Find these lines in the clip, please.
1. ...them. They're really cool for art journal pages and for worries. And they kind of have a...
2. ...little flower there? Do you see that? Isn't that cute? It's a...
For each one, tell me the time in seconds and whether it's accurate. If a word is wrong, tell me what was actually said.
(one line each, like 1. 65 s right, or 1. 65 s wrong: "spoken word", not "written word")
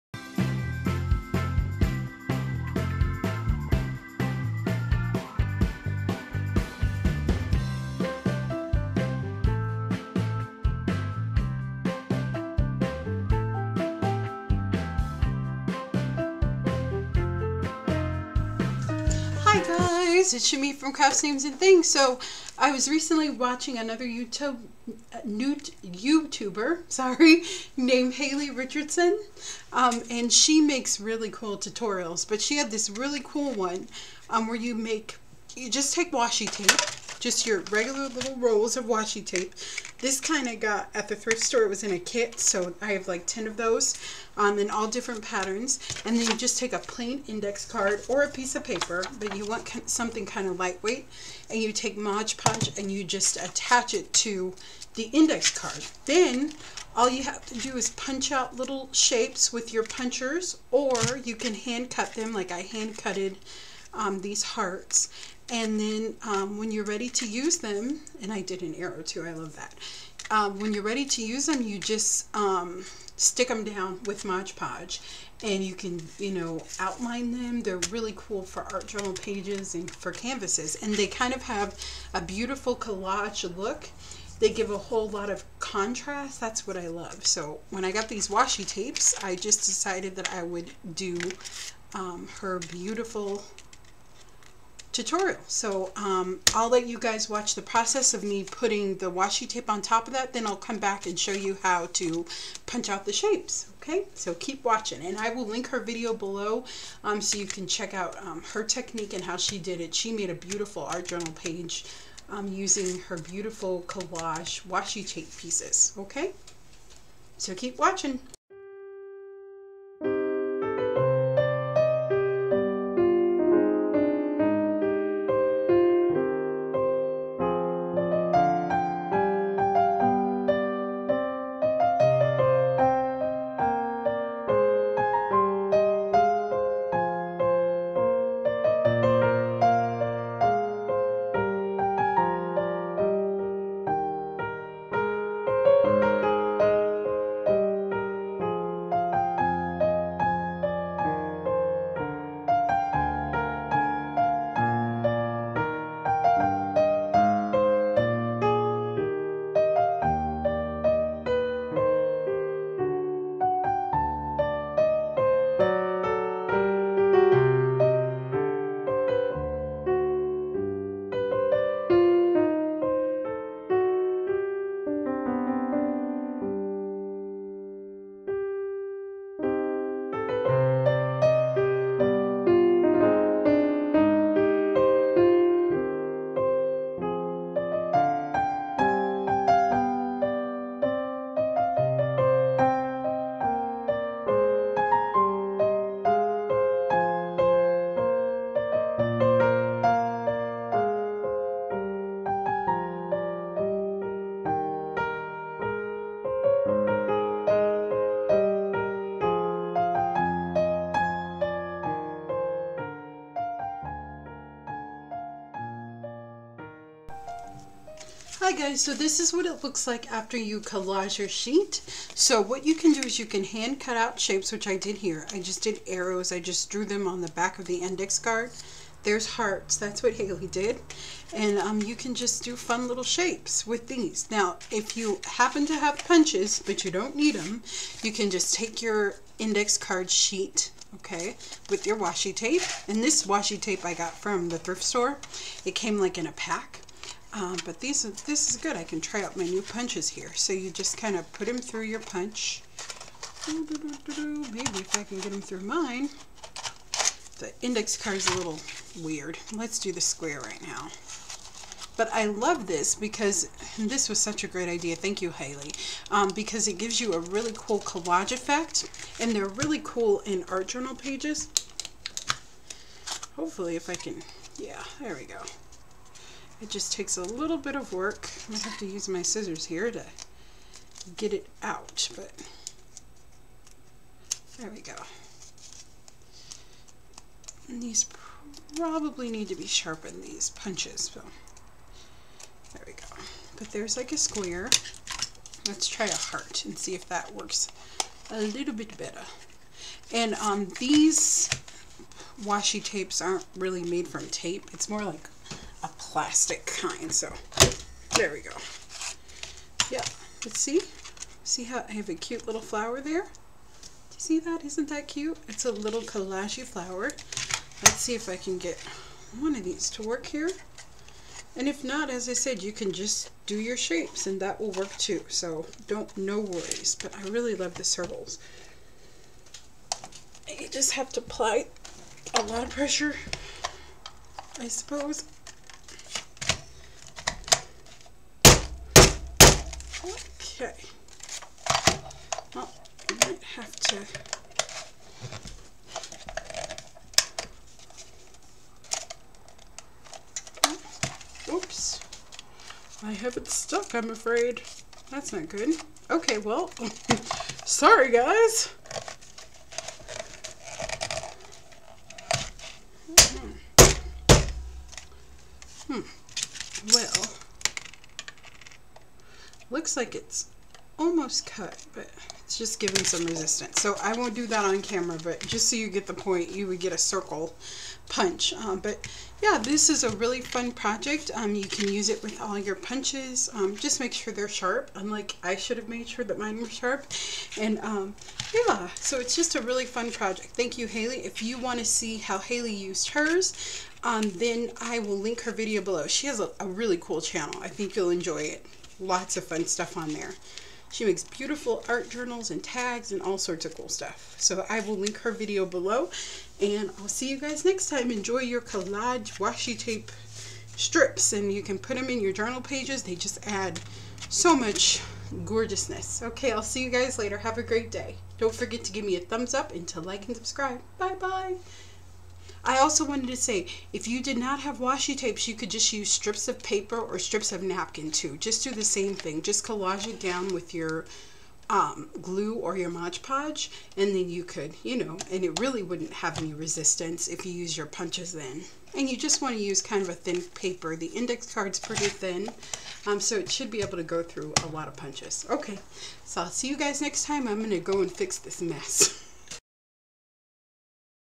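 1. 77 s wrong: "canvases", not "worries"
2. 312 s right.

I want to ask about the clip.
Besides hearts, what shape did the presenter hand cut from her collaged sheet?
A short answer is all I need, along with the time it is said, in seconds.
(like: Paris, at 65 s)
arrow, at 68 s.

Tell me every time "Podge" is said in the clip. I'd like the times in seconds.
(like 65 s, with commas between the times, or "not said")
52 s, 74 s, 433 s.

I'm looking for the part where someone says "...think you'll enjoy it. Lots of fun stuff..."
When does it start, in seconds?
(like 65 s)
397 s.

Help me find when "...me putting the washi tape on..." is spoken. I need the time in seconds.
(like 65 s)
98 s.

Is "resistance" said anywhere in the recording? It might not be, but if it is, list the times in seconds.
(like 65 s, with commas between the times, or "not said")
373 s, 436 s.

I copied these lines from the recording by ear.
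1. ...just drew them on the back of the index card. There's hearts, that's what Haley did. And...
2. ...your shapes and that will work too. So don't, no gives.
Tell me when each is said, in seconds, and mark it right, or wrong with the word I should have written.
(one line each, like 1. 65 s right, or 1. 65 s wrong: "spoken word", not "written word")
1. 226 s right
2. 323 s wrong: "worries", not "gives".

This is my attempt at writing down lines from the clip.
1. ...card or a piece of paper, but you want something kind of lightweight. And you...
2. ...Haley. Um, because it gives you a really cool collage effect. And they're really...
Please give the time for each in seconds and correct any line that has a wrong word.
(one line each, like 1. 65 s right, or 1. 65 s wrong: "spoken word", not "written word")
1. 47 s right
2. 265 s right.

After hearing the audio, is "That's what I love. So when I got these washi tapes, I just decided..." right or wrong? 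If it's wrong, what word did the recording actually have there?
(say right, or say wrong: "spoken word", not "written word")
right.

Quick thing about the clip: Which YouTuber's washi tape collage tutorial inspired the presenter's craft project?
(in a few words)
Haley Richardson.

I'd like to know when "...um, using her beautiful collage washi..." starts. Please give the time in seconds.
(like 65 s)
112 s.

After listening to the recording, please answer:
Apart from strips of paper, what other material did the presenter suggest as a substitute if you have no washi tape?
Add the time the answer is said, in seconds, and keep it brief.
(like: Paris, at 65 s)
napkin, at 427 s.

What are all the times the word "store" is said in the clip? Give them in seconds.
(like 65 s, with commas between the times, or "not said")
41 s, 244 s.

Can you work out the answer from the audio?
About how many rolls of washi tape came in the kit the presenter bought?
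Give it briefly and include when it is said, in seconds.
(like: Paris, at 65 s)
10, at 43 s.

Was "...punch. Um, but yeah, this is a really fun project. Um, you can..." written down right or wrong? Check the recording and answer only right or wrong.
right.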